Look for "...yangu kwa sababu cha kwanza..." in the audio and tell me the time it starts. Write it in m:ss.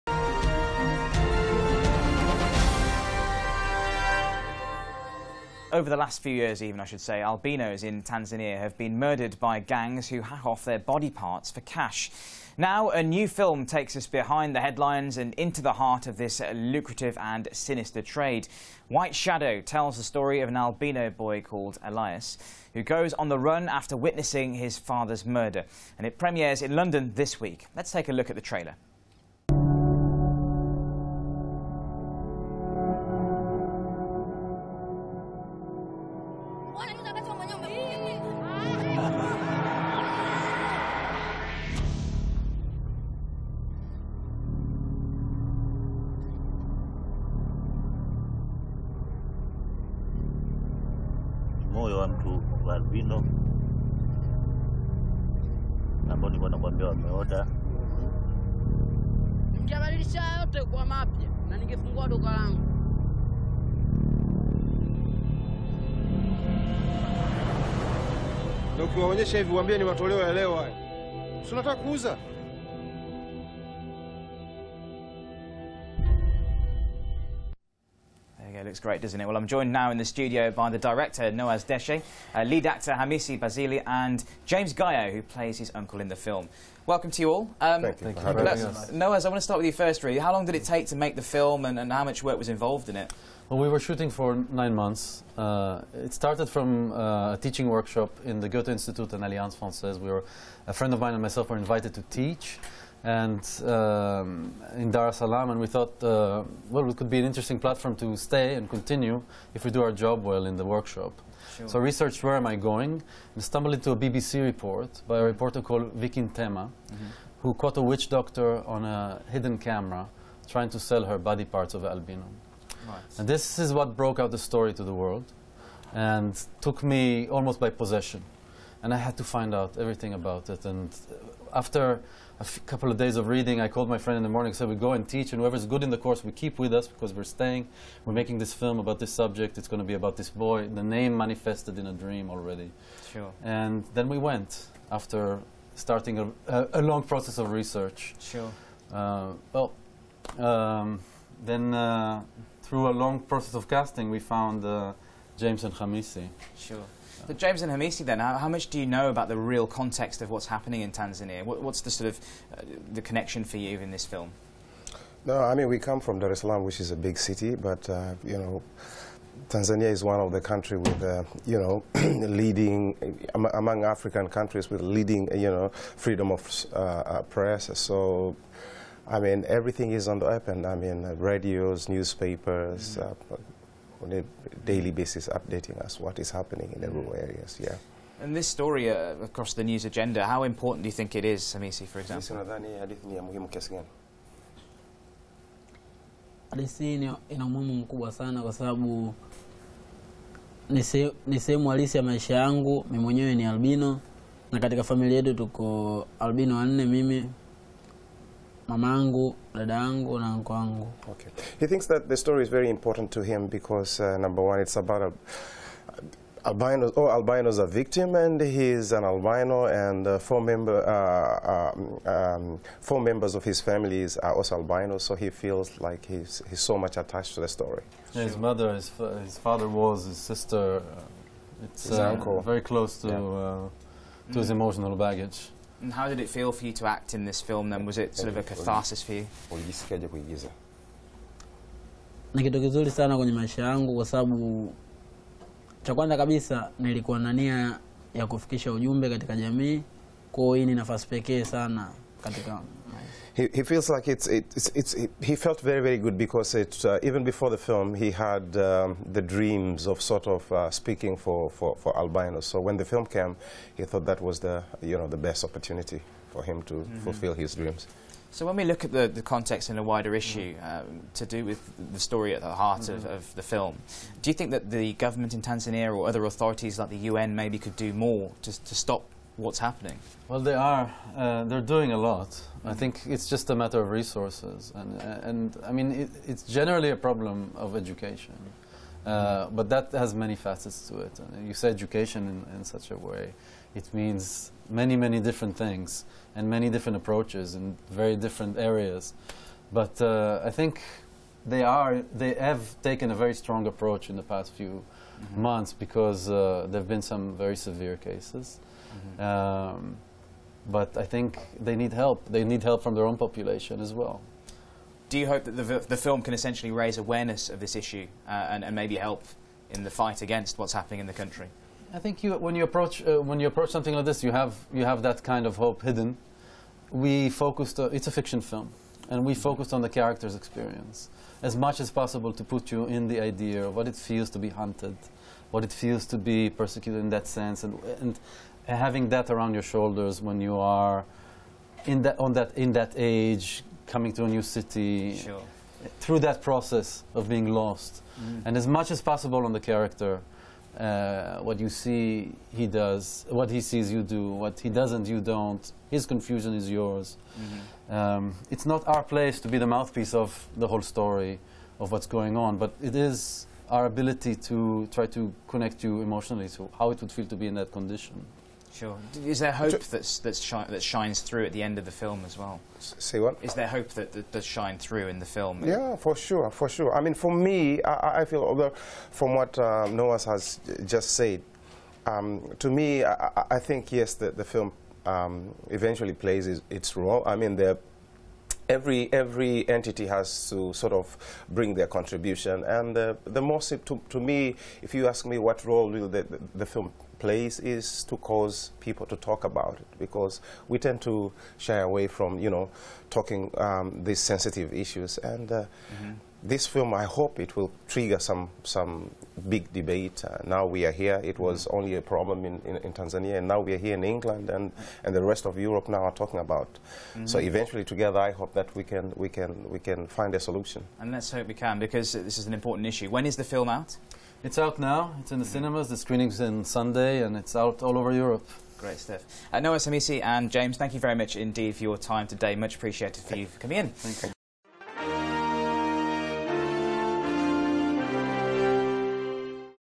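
4:03.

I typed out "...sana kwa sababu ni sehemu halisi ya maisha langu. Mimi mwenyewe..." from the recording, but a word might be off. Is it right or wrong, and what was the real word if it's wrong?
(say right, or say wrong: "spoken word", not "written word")
wrong: "yangu", not "langu".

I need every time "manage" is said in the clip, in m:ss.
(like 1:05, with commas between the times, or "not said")
not said.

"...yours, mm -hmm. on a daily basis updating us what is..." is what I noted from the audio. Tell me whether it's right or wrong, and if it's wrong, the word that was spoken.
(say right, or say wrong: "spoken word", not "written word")
wrong: "newspapers", not "yours".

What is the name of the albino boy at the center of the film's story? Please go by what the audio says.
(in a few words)
Elias.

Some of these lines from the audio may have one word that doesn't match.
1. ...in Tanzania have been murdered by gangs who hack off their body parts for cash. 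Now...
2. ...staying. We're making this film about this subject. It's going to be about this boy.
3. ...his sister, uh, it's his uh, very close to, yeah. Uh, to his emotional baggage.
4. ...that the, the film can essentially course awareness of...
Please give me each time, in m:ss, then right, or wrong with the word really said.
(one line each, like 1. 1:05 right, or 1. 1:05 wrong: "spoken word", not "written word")
1. 0:07 right
2. 2:17 right
3. 3:50 right
4. 5:15 wrong: "raise", not "course".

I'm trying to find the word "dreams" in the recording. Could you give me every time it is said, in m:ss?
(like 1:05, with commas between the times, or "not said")
2:21, 4:19, 4:27.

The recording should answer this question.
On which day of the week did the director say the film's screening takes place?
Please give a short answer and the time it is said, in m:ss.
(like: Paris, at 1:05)
Sunday, at 7:06.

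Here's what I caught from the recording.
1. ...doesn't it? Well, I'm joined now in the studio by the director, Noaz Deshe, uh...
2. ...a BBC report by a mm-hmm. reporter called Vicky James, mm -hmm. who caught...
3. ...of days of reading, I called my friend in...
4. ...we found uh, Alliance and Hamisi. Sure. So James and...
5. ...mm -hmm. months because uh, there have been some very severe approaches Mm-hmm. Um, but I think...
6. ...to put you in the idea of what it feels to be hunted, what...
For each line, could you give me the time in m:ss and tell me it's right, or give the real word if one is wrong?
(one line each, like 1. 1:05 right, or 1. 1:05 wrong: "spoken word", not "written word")
1. 1:19 right
2. 1:53 wrong: "Ntetema", not "James"
3. 2:12 right
4. 2:34 wrong: "James", not "Alliance"
5. 5:04 wrong: "cases", not "approaches"
6. 5:32 right.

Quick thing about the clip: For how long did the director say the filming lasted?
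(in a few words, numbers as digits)
9 months.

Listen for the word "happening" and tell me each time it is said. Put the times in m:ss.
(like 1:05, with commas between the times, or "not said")
2:40, 3:06, 4:39, 5:20.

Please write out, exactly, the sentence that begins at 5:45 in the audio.
through that process of being lost, mm.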